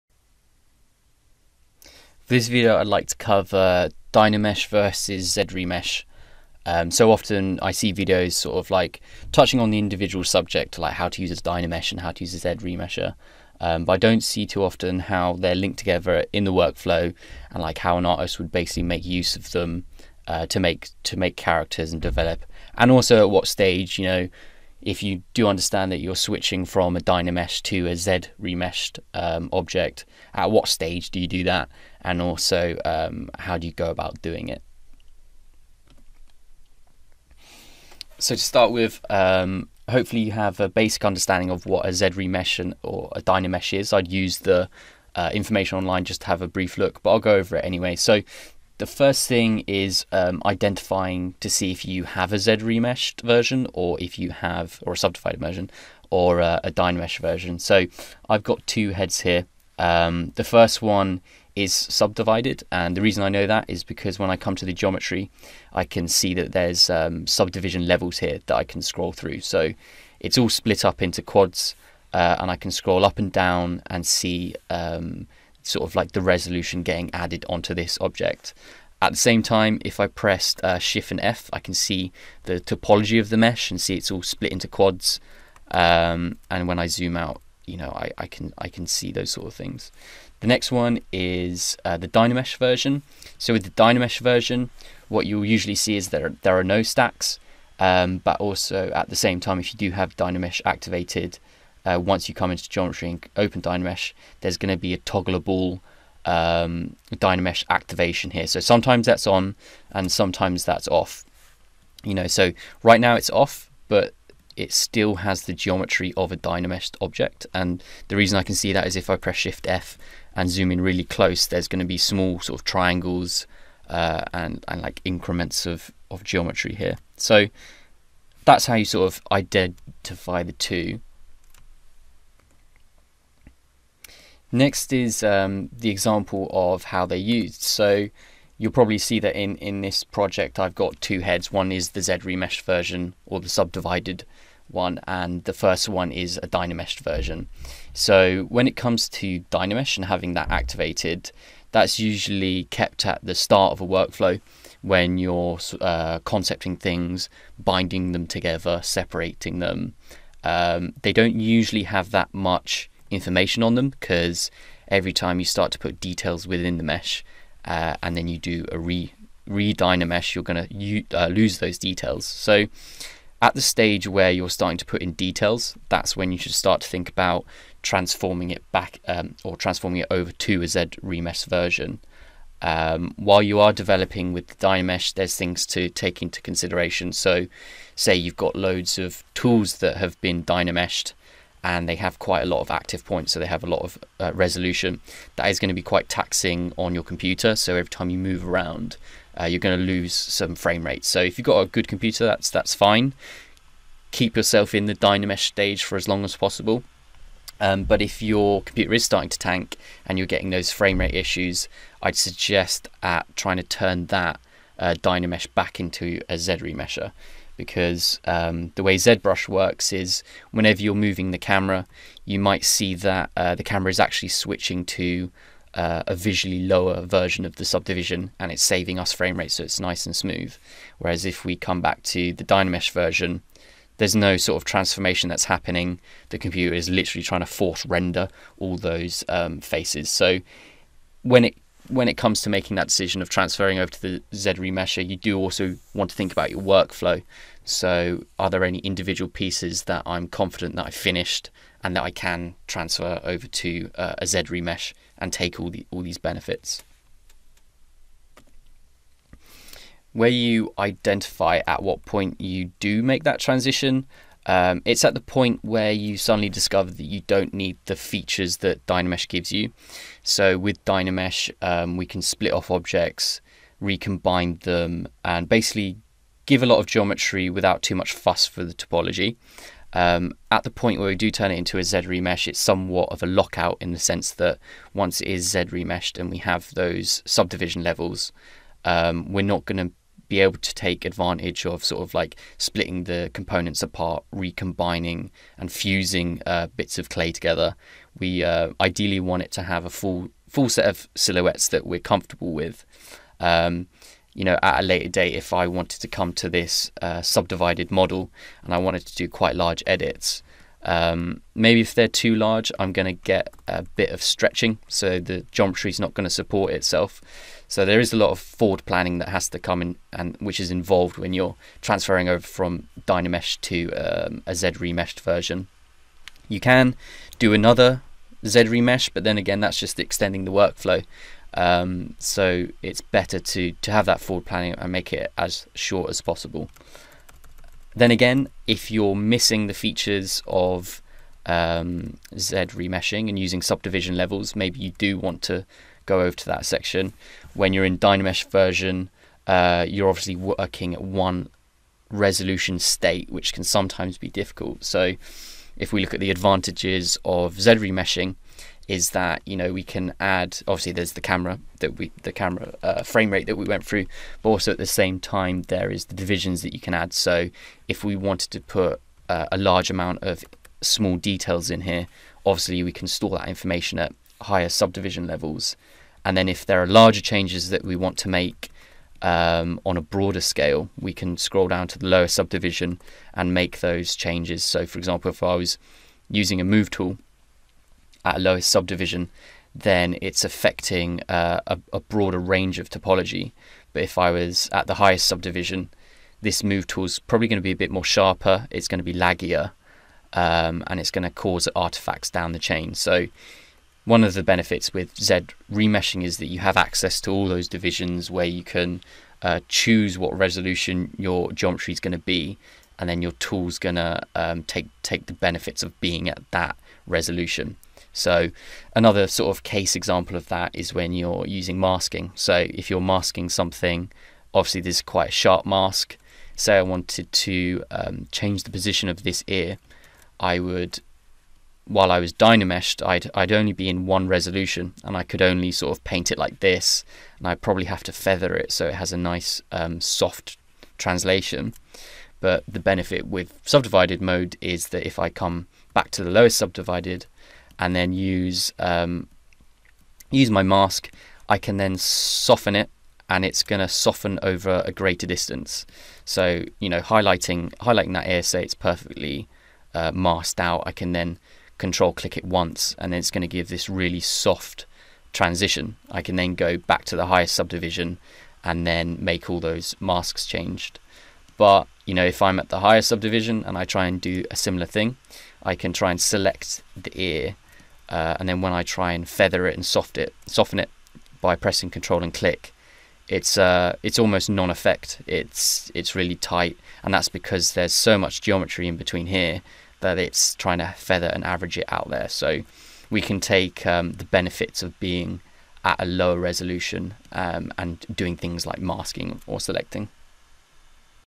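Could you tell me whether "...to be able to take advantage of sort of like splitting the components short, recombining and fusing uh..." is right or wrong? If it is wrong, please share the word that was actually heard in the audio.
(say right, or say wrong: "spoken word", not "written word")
wrong: "apart", not "short".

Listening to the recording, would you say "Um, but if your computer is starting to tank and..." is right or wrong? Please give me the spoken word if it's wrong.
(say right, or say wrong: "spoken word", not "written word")
right.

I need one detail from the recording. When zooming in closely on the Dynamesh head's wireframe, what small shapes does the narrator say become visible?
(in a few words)
triangles.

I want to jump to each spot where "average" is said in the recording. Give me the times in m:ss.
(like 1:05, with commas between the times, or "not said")
8:11.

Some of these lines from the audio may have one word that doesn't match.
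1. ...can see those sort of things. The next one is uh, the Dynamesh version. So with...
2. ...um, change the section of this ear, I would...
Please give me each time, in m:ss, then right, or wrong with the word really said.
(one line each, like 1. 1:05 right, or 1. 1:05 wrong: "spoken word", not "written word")
1. 1:28 right
2. 7:07 wrong: "position", not "section".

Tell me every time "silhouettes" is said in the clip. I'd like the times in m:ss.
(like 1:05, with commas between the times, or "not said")
5:01.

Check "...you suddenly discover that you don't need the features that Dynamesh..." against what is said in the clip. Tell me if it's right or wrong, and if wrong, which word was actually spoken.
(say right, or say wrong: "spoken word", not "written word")
right.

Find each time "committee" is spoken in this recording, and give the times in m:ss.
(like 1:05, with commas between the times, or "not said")
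not said.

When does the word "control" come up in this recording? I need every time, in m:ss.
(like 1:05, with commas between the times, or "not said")
7:41, 8:01.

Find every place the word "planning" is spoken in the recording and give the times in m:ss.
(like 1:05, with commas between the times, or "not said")
5:18, 5:34.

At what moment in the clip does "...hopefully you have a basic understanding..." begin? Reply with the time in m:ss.
0:39.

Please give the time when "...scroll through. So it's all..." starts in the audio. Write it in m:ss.
1:08.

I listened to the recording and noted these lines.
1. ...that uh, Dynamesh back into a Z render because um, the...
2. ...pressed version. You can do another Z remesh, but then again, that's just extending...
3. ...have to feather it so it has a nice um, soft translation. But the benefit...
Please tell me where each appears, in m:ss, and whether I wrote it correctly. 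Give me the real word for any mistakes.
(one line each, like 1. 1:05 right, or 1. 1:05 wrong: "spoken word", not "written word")
1. 3:34 wrong: "remesher", not "render"
2. 5:24 wrong: "remeshed", not "pressed"
3. 7:17 right.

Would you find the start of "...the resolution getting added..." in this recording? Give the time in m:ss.
1:16.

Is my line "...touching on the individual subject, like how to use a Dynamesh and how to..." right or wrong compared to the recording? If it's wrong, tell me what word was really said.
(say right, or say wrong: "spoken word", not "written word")
right.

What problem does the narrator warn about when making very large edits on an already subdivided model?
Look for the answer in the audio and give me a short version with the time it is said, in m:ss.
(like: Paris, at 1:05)
stretching, at 5:14.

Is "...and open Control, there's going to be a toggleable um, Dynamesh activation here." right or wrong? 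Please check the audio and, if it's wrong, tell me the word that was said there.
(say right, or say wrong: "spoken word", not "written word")
wrong: "Dynamesh", not "Control".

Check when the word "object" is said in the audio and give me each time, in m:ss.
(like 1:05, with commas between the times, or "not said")
0:29, 1:18, 1:57, 4:32.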